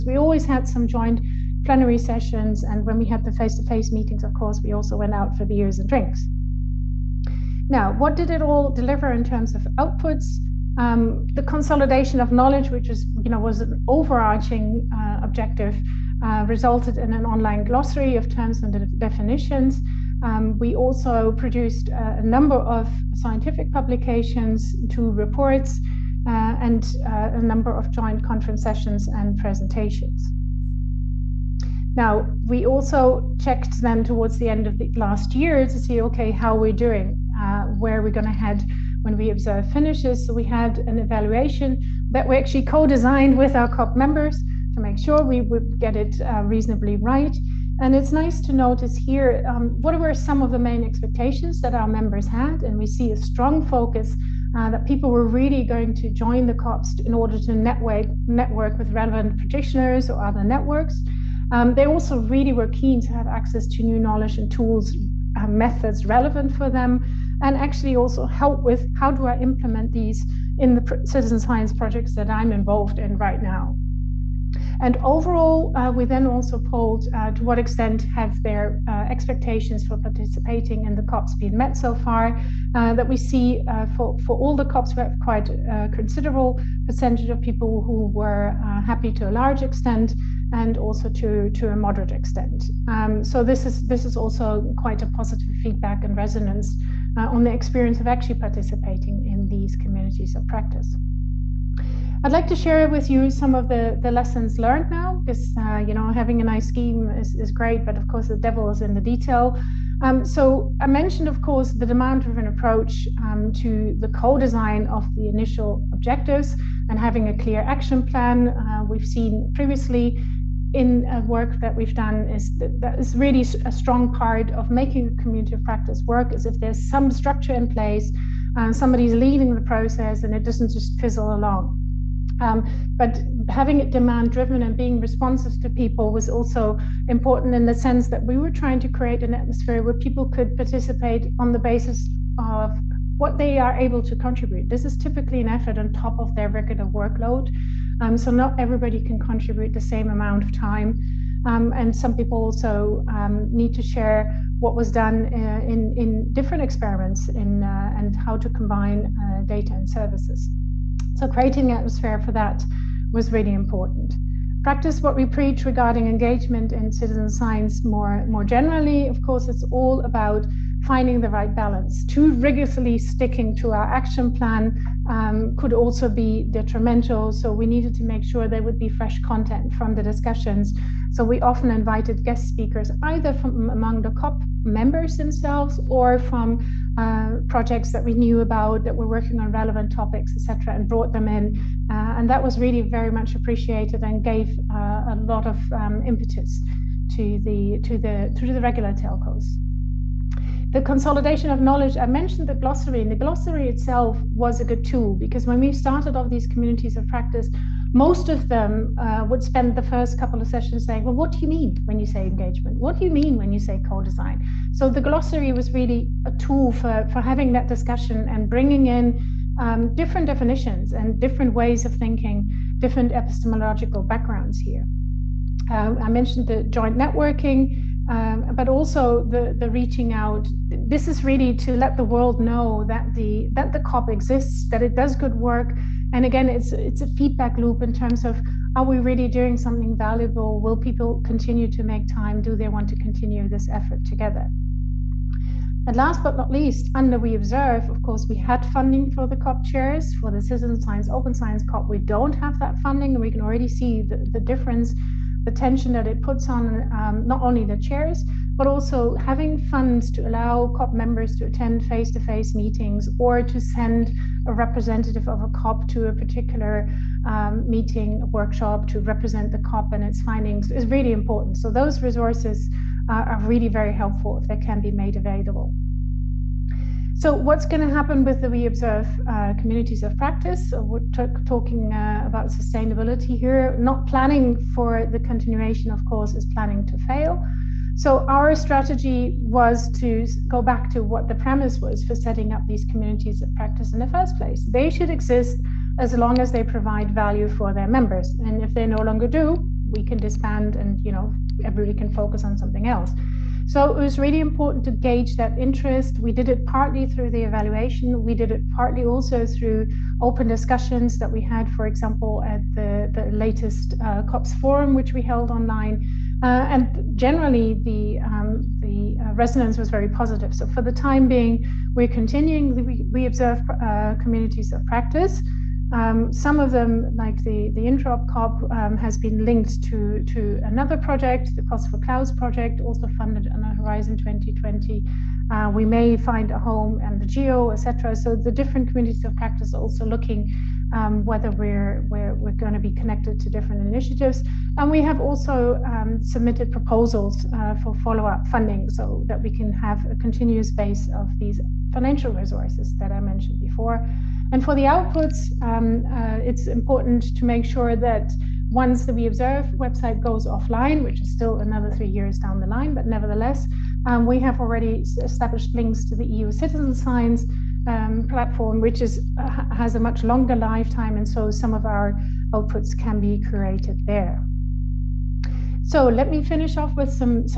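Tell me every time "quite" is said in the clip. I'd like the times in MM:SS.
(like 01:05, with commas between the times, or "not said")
01:25, 01:34.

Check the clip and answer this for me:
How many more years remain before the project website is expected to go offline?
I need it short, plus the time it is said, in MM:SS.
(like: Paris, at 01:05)
3 years, at 06:01.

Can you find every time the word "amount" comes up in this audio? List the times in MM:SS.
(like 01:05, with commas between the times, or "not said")
02:30.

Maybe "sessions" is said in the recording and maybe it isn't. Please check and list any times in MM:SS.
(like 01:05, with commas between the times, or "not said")
00:01, 00:28, 03:30.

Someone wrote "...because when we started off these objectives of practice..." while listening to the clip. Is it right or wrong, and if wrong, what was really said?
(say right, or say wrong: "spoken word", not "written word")
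wrong: "communities", not "objectives".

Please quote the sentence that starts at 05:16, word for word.
Uh, and generally, the, um, the uh, resonance was very positive.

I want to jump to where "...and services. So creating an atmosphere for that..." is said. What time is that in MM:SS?
02:39.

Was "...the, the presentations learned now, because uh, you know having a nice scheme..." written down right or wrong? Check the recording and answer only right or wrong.
wrong.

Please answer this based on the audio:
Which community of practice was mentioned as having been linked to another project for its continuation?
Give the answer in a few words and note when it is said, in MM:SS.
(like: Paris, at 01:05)
Interop COP, at 05:27.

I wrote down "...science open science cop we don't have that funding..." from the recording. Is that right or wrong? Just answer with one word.
right.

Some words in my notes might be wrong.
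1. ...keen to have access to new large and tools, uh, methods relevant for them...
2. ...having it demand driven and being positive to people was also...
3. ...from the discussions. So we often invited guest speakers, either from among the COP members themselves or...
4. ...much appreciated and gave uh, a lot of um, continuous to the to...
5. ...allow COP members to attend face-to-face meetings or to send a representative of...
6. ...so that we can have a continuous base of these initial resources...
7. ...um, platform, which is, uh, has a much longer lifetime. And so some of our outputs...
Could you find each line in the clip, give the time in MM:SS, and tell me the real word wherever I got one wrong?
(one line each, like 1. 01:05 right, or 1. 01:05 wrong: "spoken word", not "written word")
1. 01:02 wrong: "knowledge", not "large"
2. 02:13 wrong: "responsive", not "positive"
3. 02:59 right
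4. 03:13 wrong: "impetus", not "continuous"
5. 04:20 right
6. 05:48 wrong: "financial", not "initial"
7. 06:07 right.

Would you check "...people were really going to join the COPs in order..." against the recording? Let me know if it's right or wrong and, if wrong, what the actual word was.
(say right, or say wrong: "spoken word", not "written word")
right.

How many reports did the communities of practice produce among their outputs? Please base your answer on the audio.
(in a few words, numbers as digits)
2.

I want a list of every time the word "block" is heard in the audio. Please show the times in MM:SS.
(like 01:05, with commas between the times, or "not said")
not said.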